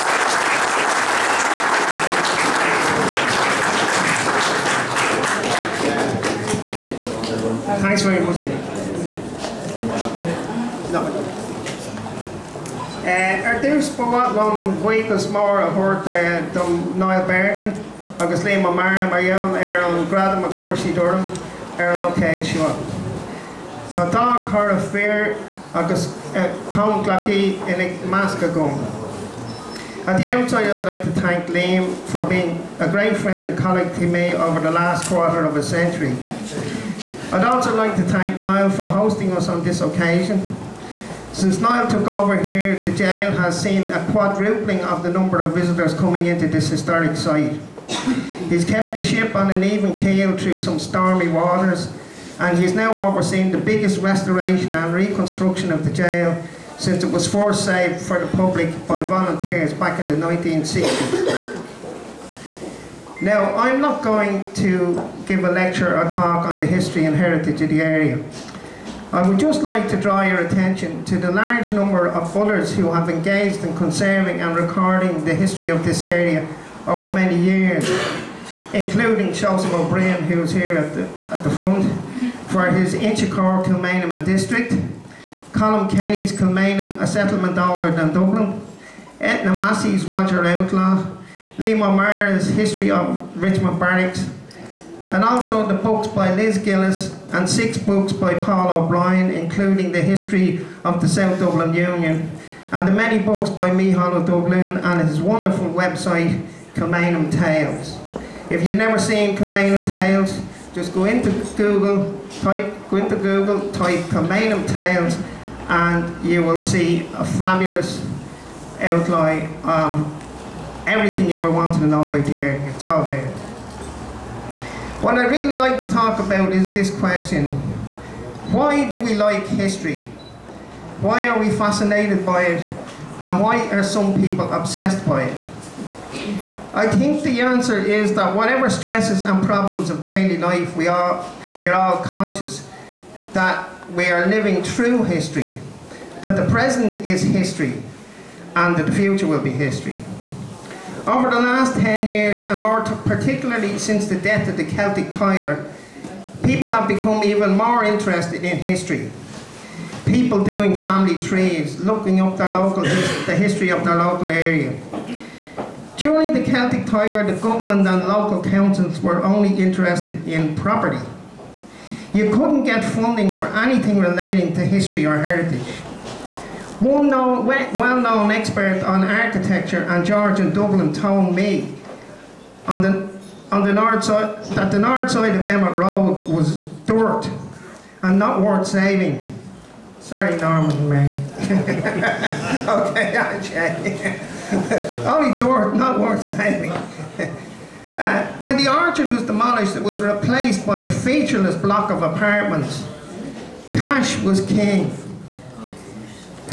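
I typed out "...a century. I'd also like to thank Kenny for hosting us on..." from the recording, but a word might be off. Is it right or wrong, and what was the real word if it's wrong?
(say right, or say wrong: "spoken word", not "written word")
wrong: "Niall", not "Kenny".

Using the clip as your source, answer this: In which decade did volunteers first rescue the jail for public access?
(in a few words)
1960s.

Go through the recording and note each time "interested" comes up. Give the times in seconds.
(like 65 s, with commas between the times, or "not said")
157 s, 169 s.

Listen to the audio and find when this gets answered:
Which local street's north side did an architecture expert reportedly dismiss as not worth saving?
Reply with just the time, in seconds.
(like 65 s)
185 s.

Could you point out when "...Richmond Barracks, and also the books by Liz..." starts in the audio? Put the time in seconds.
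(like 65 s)
93 s.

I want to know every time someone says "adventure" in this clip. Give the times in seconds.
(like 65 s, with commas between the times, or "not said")
not said.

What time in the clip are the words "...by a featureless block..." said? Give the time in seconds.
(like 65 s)
200 s.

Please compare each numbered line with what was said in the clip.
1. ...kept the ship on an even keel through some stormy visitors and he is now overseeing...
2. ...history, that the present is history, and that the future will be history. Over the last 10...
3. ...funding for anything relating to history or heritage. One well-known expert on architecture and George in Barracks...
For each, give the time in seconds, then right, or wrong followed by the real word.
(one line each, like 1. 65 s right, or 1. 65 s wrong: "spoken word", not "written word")
1. 48 s wrong: "waters", not "visitors"
2. 145 s right
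3. 172 s wrong: "Dublin", not "Barracks".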